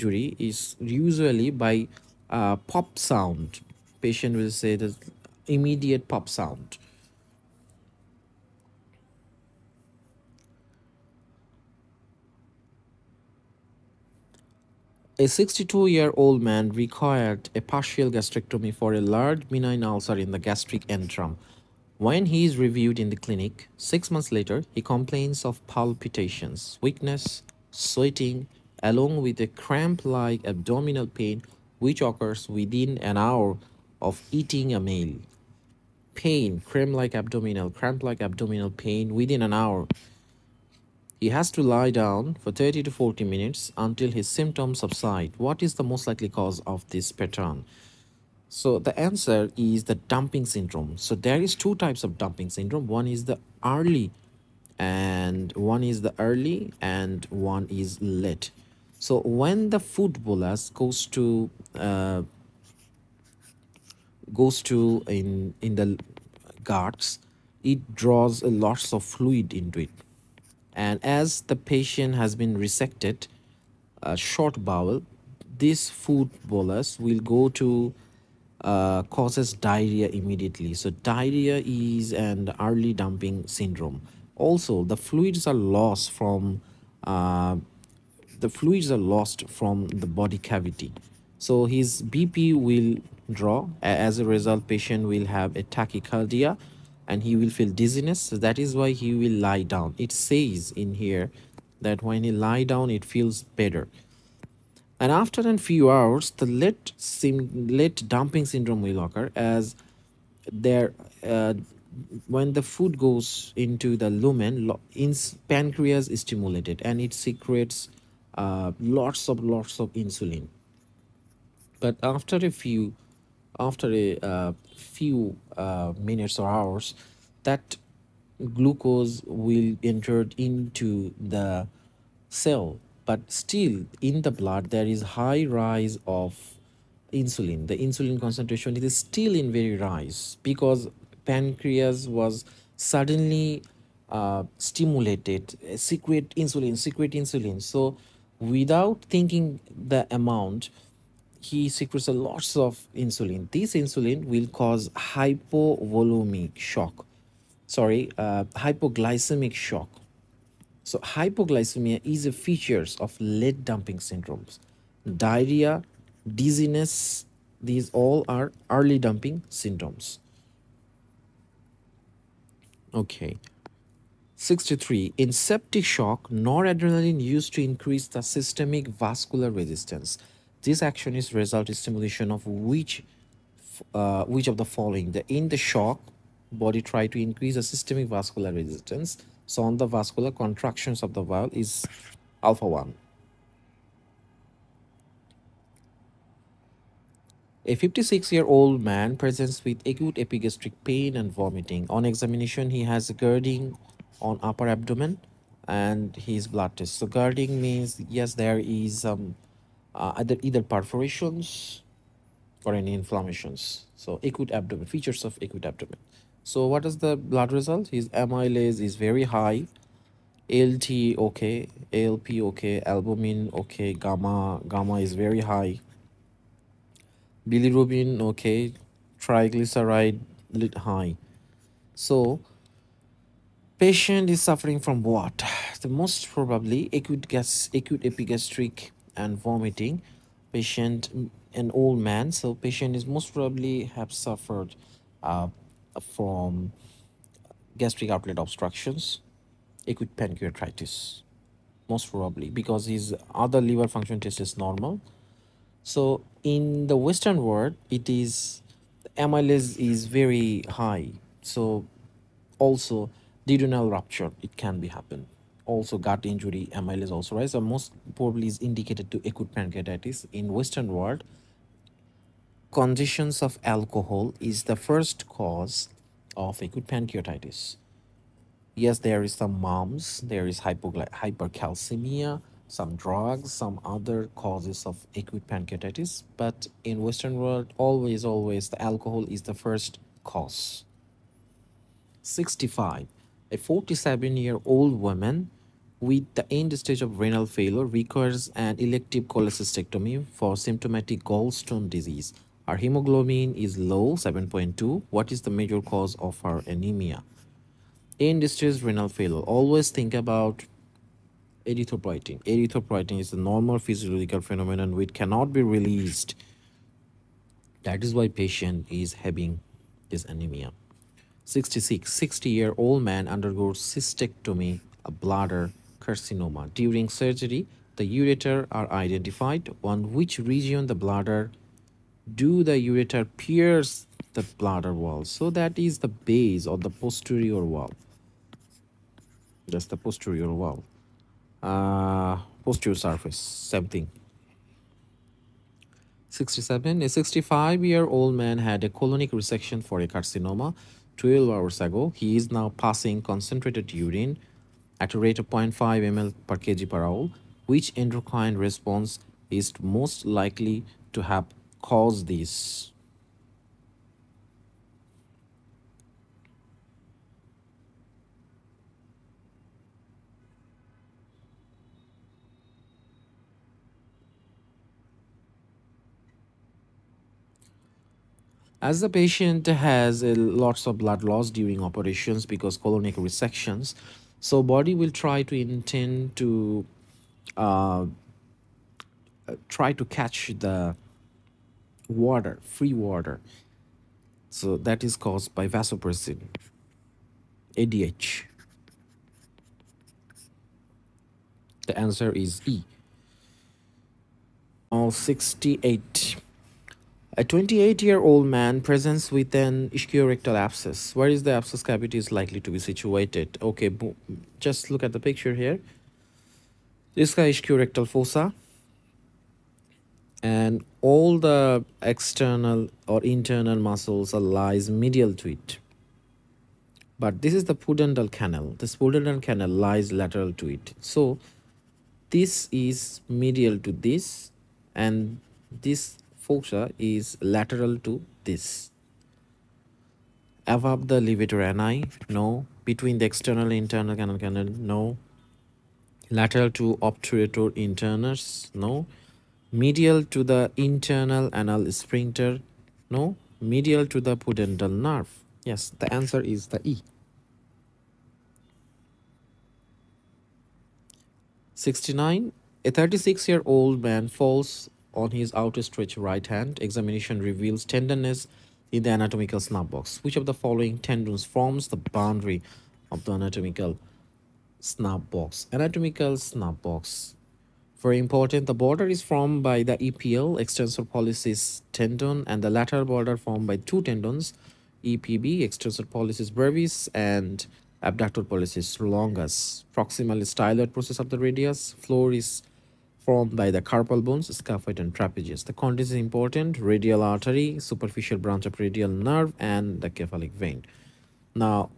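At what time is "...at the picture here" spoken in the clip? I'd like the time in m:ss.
6:55.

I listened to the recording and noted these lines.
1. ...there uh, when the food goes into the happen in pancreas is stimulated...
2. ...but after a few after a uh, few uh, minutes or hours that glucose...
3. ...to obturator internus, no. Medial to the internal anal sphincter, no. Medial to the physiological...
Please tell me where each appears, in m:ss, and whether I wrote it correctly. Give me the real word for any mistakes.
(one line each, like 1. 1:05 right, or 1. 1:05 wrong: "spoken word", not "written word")
1. 1:50 wrong: "lumen", not "happen"
2. 2:01 right
3. 7:26 wrong: "pudendal", not "physiological".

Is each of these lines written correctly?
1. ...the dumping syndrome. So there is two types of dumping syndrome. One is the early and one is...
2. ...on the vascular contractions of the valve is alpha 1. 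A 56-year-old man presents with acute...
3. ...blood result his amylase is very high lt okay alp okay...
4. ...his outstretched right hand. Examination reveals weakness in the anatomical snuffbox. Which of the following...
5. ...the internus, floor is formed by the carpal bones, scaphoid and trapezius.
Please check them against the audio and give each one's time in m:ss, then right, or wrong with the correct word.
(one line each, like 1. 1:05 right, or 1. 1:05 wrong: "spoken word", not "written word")
1. 0:49 right
2. 3:09 right
3. 3:37 right
4. 7:45 wrong: "tenderness", not "weakness"
5. 8:11 wrong: "radius", not "internus".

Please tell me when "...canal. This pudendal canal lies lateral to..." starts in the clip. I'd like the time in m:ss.
7:08.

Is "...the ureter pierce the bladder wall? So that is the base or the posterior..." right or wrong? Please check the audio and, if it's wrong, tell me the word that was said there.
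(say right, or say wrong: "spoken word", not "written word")
right.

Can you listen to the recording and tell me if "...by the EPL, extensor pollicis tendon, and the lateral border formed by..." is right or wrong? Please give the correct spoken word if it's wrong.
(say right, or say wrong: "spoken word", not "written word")
right.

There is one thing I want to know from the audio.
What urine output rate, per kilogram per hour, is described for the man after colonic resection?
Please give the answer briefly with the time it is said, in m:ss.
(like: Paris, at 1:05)
0.5 ml per kg per hour, at 5:55.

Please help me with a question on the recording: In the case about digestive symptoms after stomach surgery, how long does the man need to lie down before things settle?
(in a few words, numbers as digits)
30 to 40 minutes.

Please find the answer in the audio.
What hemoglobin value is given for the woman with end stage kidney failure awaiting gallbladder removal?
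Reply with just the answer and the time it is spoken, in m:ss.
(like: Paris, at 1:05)
7.2, at 5:04.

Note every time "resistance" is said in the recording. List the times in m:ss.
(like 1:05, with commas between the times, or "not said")
2:59, 3:08.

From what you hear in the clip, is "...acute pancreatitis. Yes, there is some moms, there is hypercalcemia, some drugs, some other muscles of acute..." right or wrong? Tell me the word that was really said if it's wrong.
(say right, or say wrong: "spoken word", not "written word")
wrong: "causes", not "muscles".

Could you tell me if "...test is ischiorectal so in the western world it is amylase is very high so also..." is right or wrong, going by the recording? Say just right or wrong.
wrong.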